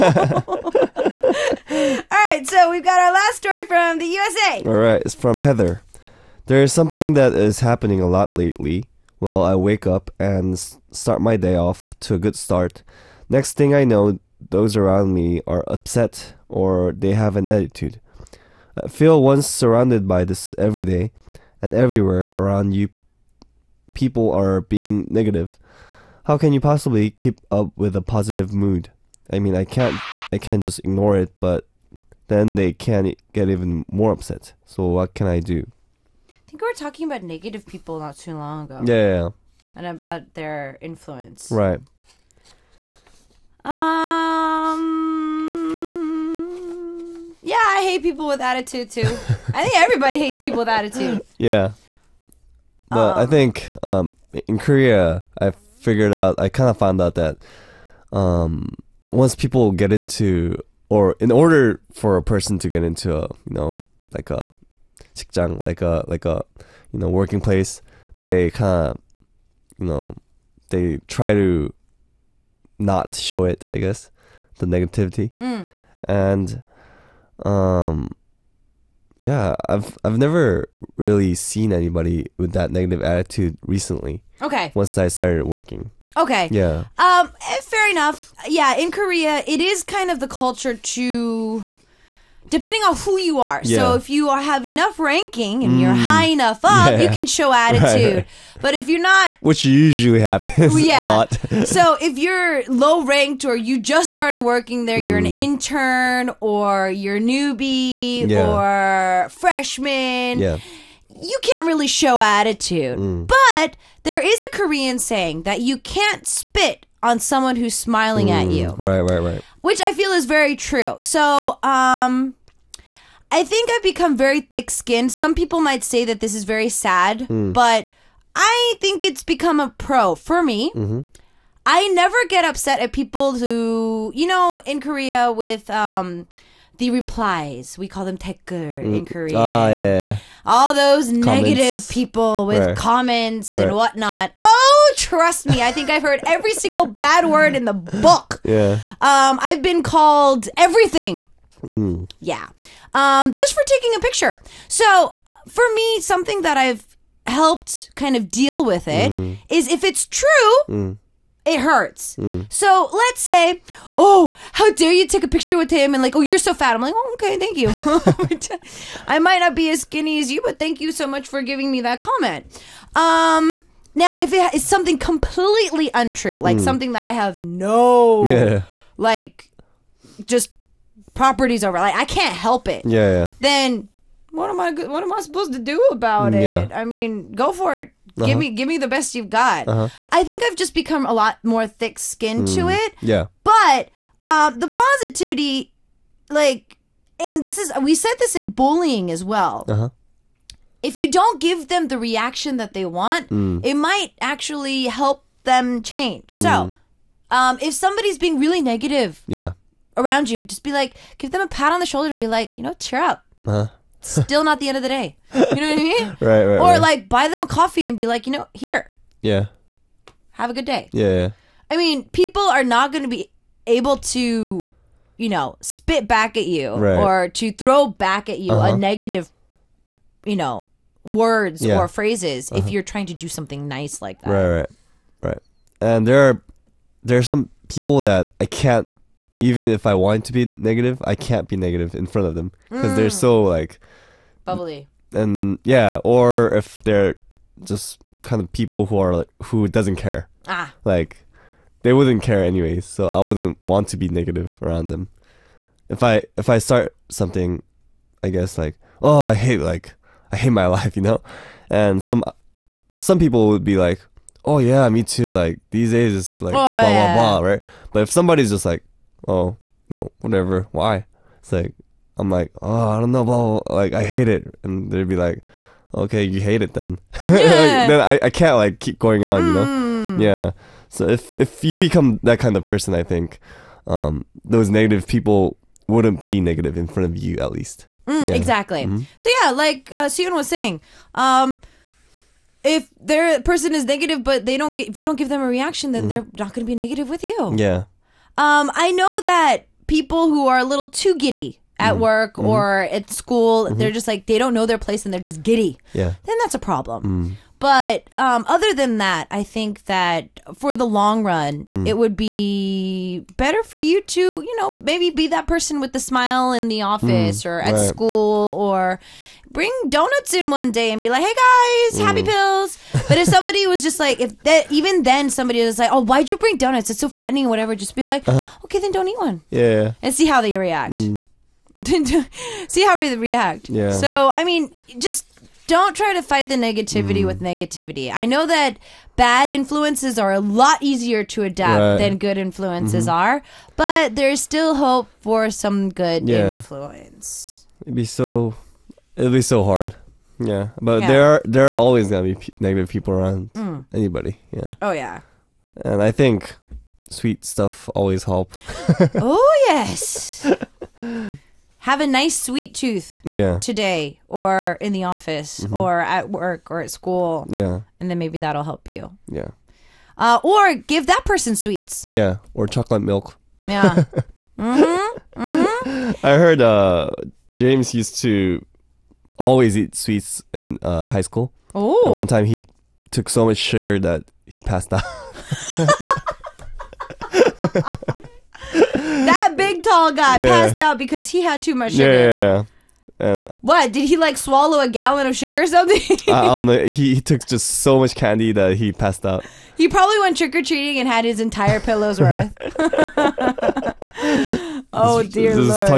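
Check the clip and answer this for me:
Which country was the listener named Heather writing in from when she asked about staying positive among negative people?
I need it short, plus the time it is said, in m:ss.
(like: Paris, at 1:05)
USA, at 0:04.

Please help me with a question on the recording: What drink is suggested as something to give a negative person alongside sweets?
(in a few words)
Chocolate milk.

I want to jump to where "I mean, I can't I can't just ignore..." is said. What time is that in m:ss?
0:29.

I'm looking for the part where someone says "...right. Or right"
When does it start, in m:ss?
3:36.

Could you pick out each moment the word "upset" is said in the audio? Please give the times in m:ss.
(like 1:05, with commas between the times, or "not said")
0:15, 0:34, 2:12.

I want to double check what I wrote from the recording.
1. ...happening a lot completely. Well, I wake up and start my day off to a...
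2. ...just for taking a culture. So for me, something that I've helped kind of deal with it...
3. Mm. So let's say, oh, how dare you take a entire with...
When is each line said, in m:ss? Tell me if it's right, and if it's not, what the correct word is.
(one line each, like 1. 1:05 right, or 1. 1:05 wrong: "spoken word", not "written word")
1. 0:07 wrong: "lately", not "completely"
2. 2:33 wrong: "picture", not "culture"
3. 2:42 wrong: "picture", not "entire".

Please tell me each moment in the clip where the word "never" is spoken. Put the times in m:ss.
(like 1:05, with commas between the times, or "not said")
1:20, 2:11.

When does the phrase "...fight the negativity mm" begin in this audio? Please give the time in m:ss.
5:36.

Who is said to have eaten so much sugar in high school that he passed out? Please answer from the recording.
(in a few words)
James.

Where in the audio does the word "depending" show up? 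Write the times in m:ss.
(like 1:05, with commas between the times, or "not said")
1:32.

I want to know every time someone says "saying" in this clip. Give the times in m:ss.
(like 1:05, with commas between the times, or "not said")
1:54, 4:50.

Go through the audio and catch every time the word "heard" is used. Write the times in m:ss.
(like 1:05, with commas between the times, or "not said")
2:26, 6:16.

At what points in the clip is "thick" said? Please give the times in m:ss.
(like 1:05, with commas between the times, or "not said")
2:04, 3:11.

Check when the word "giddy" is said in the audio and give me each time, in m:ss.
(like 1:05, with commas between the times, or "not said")
5:01, 5:05.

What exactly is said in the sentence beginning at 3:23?
it might actually help them change.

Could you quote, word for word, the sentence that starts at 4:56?
they're not going to be negative with you.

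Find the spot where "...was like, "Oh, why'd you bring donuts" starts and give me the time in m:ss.
5:25.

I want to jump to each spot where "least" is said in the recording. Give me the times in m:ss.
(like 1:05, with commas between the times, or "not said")
4:47.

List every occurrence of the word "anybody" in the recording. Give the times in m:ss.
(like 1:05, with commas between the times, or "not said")
1:21, 5:53.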